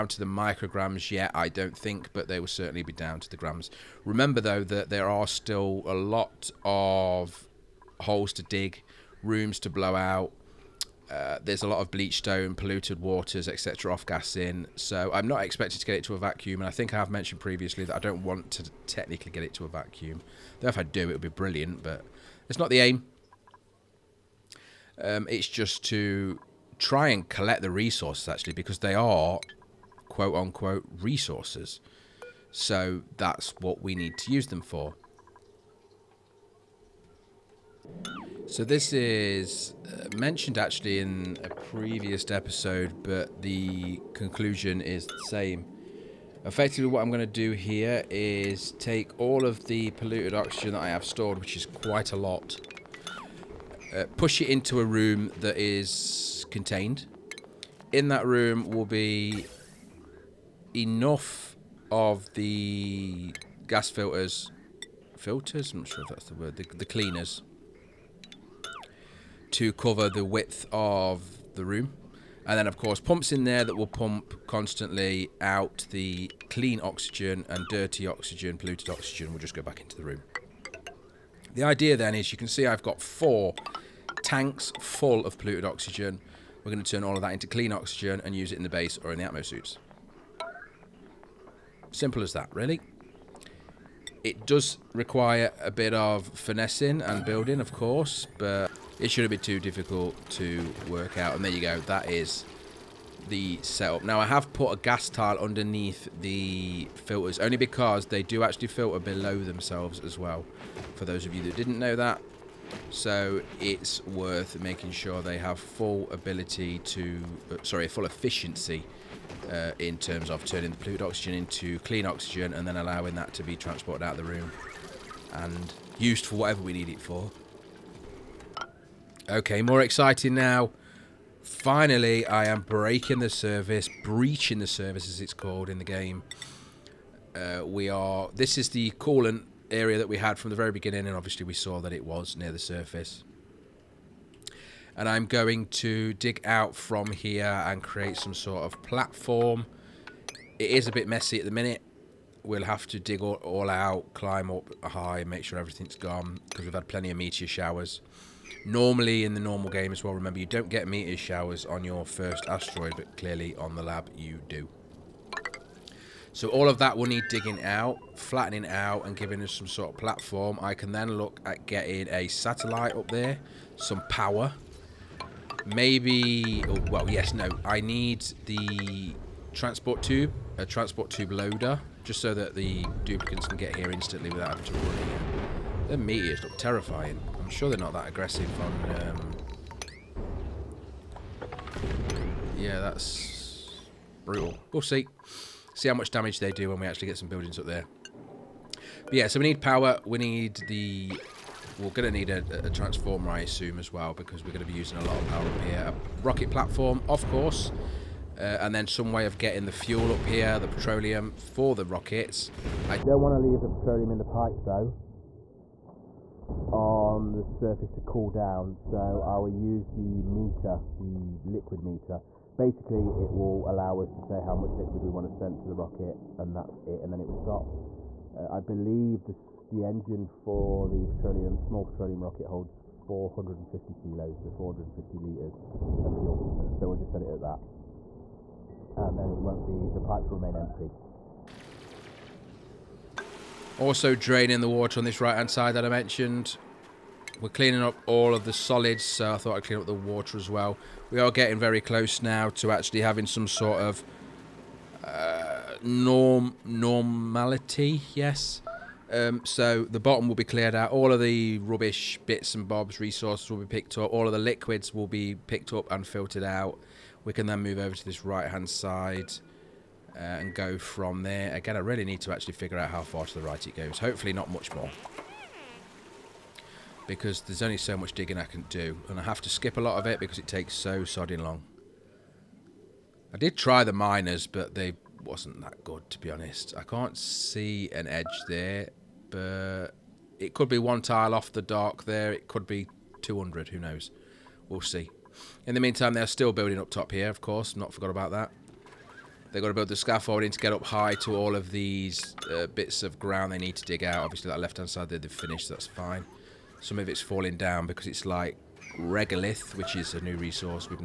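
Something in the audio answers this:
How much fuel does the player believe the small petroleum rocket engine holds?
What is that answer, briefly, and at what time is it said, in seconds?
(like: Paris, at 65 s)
450 kilos, at 232 s.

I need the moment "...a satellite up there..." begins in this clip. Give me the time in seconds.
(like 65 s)
172 s.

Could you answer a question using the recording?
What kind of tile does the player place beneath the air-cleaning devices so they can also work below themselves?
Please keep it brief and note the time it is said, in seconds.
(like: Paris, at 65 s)
Gas tile, at 104 s.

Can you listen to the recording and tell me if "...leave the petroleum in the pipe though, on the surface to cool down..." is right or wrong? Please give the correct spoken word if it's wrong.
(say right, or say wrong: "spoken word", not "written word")
right.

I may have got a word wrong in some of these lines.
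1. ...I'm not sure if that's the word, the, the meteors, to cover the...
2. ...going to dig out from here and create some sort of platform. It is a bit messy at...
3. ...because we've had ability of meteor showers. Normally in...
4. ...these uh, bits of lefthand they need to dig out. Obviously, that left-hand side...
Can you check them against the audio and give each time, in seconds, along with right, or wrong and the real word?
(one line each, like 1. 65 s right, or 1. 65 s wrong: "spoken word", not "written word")
1. 65 s wrong: "cleaners", not "meteors"
2. 145 s right
3. 156 s wrong: "plenty", not "ability"
4. 301 s wrong: "ground", not "lefthand".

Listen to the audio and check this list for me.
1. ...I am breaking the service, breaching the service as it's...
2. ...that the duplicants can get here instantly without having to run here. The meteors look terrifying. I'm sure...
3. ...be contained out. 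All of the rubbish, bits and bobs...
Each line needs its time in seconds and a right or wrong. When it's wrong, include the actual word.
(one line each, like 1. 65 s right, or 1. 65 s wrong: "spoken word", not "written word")
1. 132 s right
2. 182 s right
3. 260 s wrong: "cleared", not "contained".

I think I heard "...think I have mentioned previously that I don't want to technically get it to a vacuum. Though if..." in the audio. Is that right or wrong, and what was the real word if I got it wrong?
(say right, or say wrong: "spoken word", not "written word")
right.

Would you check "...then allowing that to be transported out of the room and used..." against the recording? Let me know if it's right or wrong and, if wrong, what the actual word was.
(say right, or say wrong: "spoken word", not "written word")
right.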